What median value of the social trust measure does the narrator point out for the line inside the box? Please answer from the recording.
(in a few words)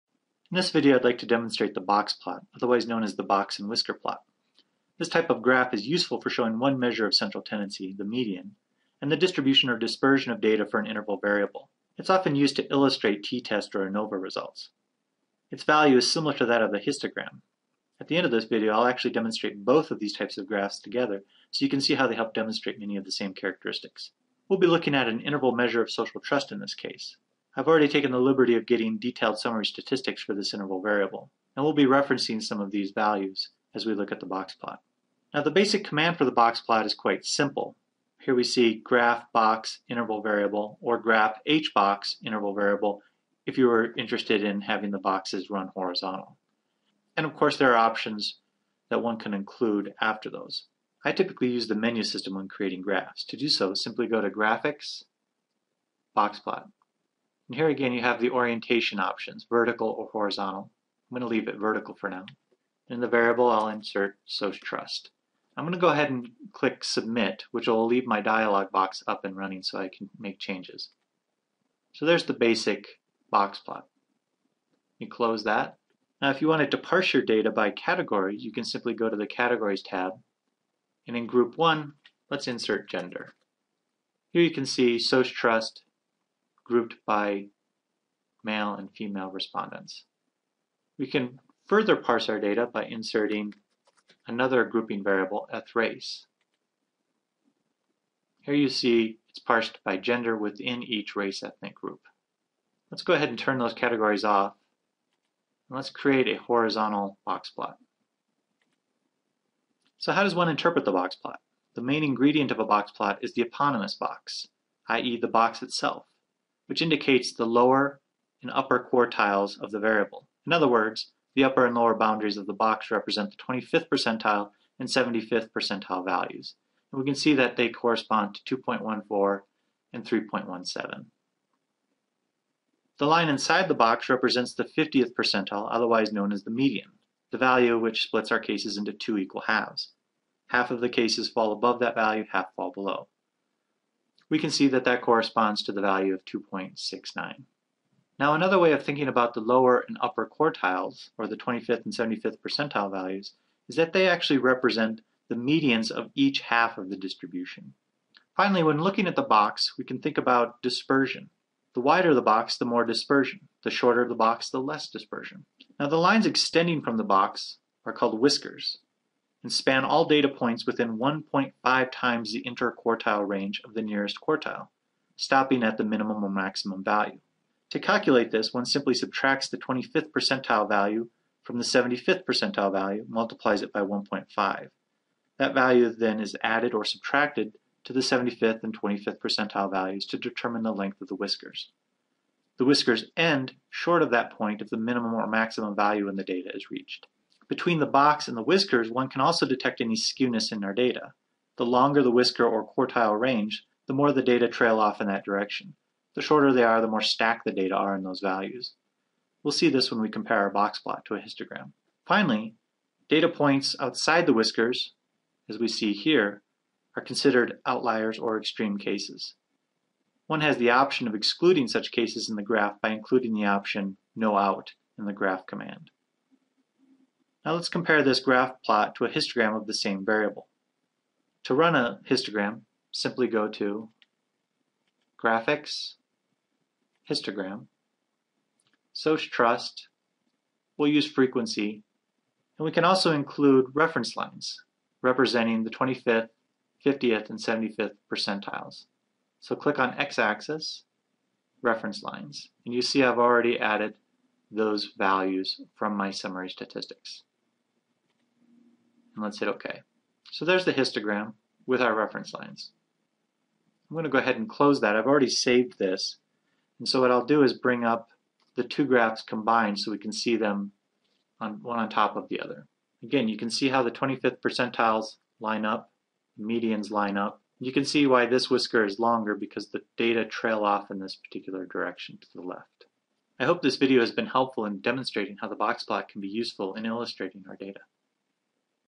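2.69.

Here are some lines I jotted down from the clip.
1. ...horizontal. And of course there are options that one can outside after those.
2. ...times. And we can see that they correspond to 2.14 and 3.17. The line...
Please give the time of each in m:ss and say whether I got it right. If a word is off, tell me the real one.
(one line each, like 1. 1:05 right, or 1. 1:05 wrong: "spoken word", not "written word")
1. 0:45 wrong: "include", not "outside"
2. 2:06 wrong: "values", not "times".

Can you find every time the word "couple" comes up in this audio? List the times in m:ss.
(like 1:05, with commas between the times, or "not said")
not said.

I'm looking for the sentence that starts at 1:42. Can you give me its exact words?
Let's go ahead and turn those categories off.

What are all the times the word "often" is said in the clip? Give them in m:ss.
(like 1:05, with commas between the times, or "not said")
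0:12.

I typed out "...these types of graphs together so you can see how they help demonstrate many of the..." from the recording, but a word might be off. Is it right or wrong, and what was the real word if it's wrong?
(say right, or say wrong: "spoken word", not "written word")
right.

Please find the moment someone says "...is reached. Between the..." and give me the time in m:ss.
3:16.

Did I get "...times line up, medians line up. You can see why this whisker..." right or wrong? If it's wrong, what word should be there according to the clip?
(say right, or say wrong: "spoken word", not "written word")
wrong: "percentiles", not "times".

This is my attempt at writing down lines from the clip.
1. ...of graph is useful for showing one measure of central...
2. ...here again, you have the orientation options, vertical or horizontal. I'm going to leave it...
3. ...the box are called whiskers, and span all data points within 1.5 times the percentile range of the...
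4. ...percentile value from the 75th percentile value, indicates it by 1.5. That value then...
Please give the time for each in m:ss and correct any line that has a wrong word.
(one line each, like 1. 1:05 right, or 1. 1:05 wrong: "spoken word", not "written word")
1. 0:05 right
2. 0:57 right
3. 2:46 wrong: "interquartile", not "percentile"
4. 3:00 wrong: "multiplies", not "indicates".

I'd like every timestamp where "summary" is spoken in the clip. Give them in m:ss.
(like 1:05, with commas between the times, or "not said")
0:29, 4:16.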